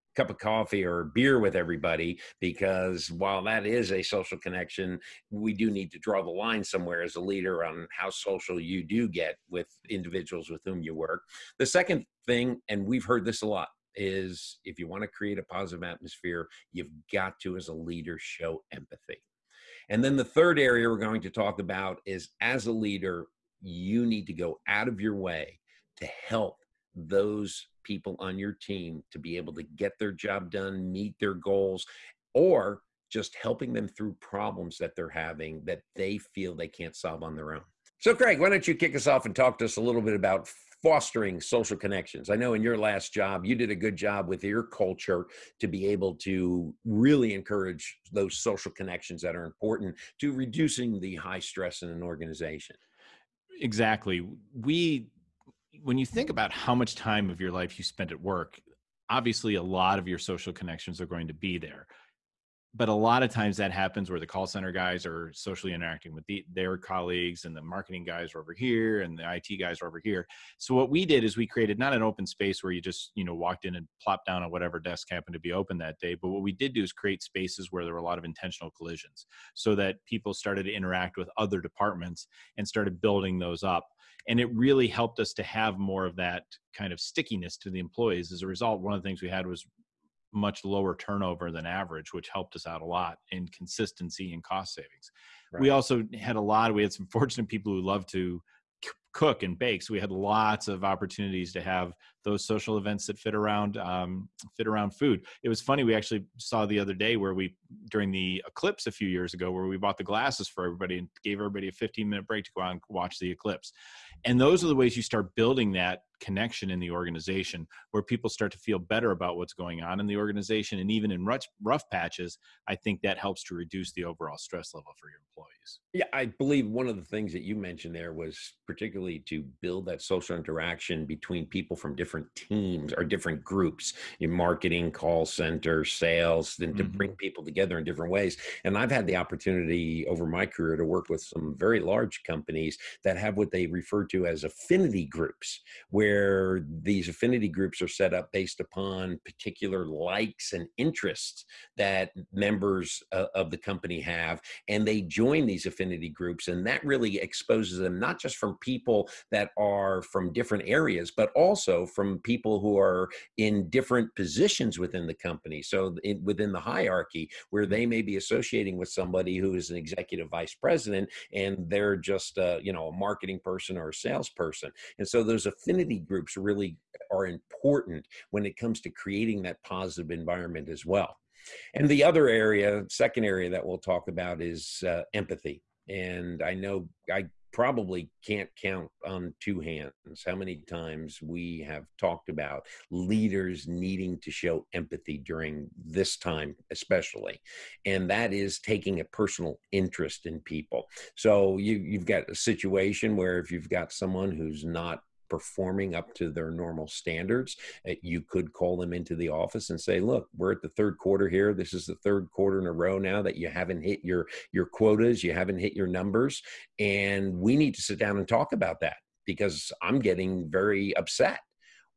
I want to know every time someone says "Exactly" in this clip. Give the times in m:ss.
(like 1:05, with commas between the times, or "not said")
0:53.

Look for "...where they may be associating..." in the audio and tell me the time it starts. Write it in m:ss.
2:47.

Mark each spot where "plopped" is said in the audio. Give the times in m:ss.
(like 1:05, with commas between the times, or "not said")
1:14.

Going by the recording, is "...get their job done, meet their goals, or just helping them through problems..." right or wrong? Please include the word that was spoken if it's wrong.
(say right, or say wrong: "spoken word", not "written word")
right.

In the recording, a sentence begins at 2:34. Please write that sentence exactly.
And they join these affinity groups.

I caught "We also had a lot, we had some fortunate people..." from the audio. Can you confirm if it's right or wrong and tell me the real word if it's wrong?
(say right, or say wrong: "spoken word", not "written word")
right.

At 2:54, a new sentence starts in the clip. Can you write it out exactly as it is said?
And so those affinity groups really are important when it comes to creating that positive environment as well.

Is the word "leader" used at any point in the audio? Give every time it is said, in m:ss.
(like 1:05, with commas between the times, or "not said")
0:07, 0:17, 0:22, 3:12.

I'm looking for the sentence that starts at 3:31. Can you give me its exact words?
This is the third quarter in a row now that you haven't hit your, your quotas, you haven't hit your numbers.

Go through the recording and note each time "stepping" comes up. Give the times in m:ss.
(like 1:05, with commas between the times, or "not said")
not said.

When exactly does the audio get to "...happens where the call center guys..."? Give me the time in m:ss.
1:03.